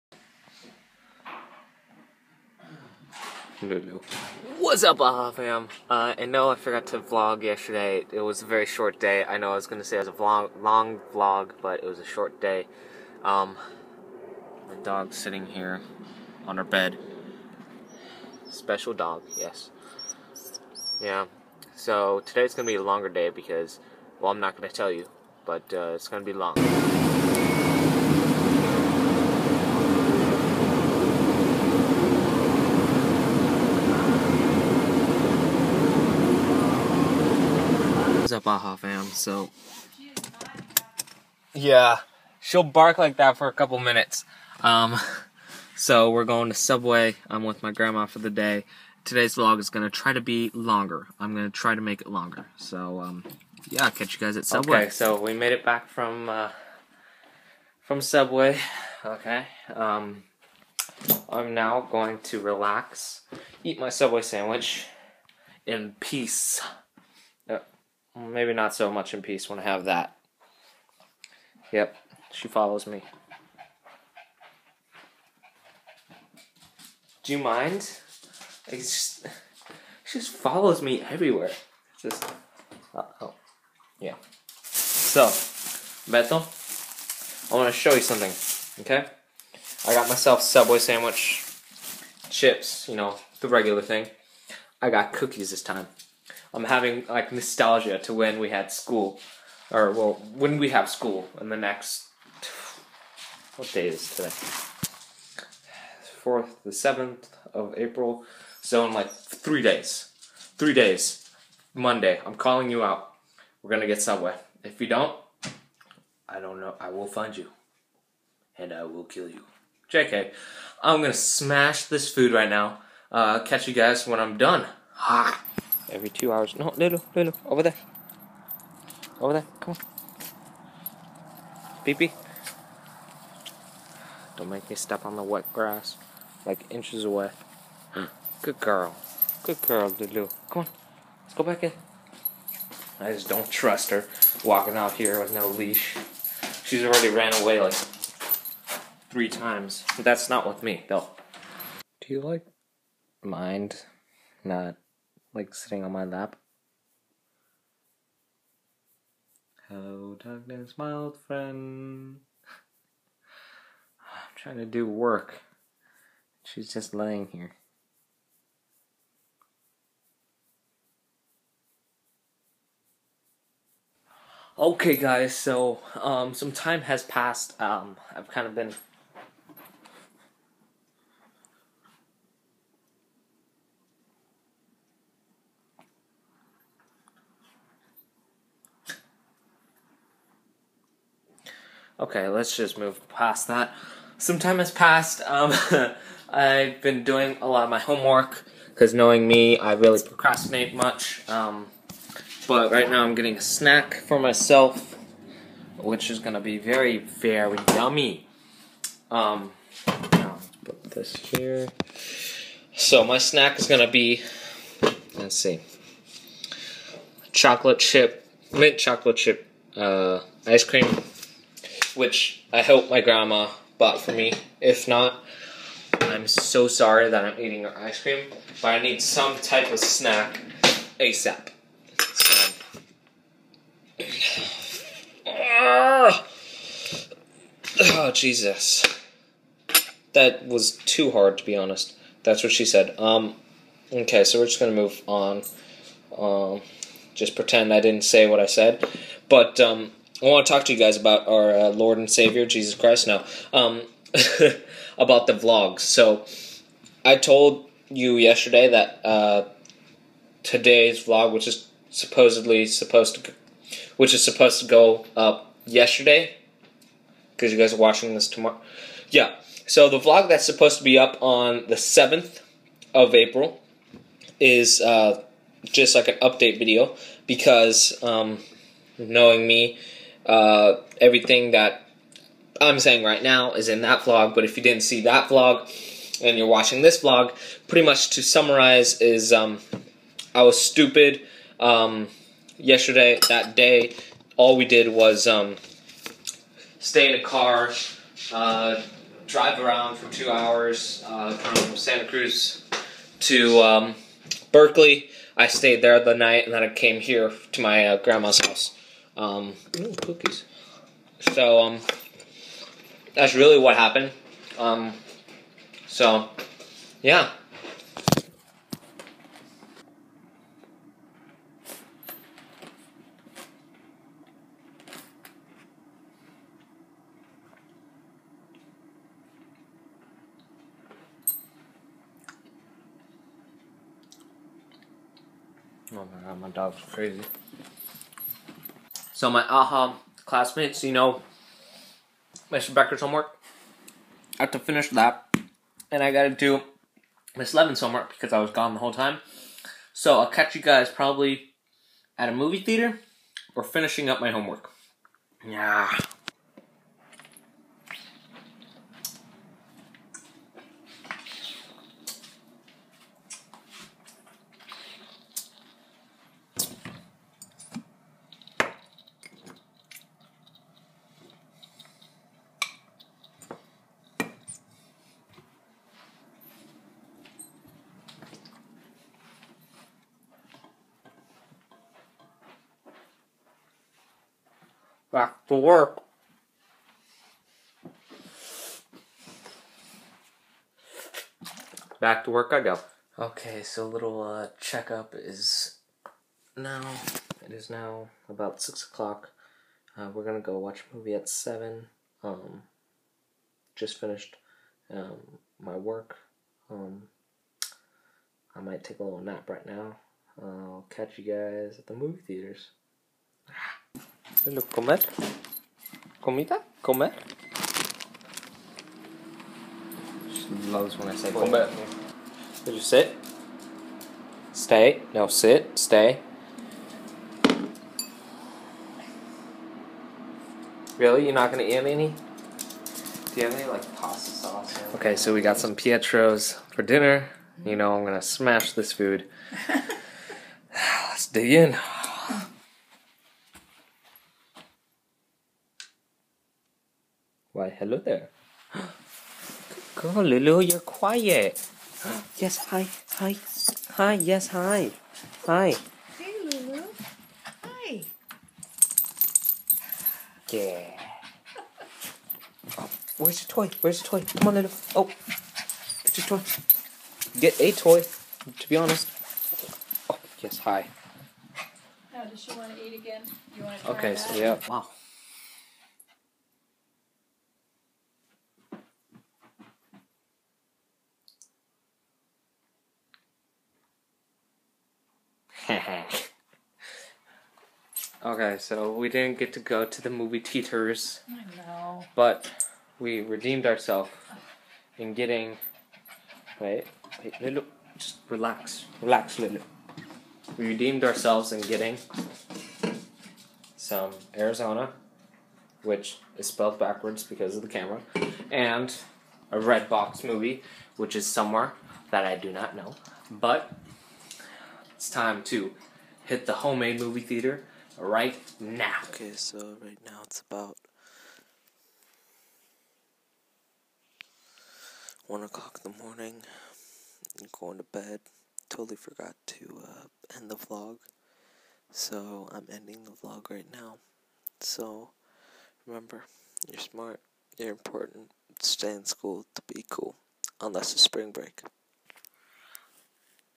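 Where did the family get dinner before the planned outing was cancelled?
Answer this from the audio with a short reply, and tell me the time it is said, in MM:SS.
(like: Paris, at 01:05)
Pietros, at 07:15.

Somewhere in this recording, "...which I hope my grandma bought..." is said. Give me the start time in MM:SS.
03:42.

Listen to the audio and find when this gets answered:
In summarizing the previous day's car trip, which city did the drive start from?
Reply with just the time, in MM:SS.
05:01.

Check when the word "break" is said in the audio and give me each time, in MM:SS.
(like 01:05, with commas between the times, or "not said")
09:01.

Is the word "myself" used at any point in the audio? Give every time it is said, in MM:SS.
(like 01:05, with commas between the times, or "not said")
01:30, 03:24.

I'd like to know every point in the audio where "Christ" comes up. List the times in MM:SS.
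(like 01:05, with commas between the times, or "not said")
04:12.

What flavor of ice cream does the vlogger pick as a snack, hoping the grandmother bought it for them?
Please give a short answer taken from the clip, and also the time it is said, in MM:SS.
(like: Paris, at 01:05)
mint chocolate chip, at 03:38.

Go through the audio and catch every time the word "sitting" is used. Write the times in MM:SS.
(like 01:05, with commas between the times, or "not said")
00:15, 02:35.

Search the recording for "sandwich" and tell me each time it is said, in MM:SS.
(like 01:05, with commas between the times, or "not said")
01:04, 01:30.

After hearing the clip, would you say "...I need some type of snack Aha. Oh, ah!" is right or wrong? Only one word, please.
wrong.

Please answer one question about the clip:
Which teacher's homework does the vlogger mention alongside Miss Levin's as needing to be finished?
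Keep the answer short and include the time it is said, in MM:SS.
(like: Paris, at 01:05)
Mr. Becker, at 05:42.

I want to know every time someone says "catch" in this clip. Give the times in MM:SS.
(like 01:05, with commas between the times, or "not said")
00:53, 02:03, 05:50, 06:50.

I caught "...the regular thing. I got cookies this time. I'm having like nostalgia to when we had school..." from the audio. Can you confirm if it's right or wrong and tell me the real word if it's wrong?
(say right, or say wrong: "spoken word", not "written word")
right.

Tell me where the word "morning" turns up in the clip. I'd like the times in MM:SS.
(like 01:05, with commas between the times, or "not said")
08:46.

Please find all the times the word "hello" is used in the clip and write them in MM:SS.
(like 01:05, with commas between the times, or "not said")
02:39, 06:54, 07:27.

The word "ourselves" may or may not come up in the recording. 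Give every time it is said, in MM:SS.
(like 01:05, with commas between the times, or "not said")
08:13, 08:21.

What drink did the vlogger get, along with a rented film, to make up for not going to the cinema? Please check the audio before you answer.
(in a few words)
Arizona.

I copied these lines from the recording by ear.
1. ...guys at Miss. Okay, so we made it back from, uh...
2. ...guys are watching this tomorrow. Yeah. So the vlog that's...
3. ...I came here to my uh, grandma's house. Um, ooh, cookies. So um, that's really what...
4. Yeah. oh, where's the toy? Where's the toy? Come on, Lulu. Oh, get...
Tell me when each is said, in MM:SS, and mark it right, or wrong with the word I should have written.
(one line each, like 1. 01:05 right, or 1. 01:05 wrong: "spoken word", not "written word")
1. 00:54 wrong: "Subway", not "Miss"
2. 04:27 right
3. 05:06 right
4. 07:40 right.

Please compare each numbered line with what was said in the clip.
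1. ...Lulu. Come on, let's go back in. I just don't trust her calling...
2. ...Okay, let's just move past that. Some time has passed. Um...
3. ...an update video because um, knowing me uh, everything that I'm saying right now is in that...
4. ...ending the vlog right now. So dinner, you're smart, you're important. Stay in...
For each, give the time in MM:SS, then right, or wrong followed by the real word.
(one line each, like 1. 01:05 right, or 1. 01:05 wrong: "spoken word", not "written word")
1. 02:19 wrong: "walking", not "calling"
2. 03:12 right
3. 04:36 right
4. 08:52 wrong: "remember", not "dinner".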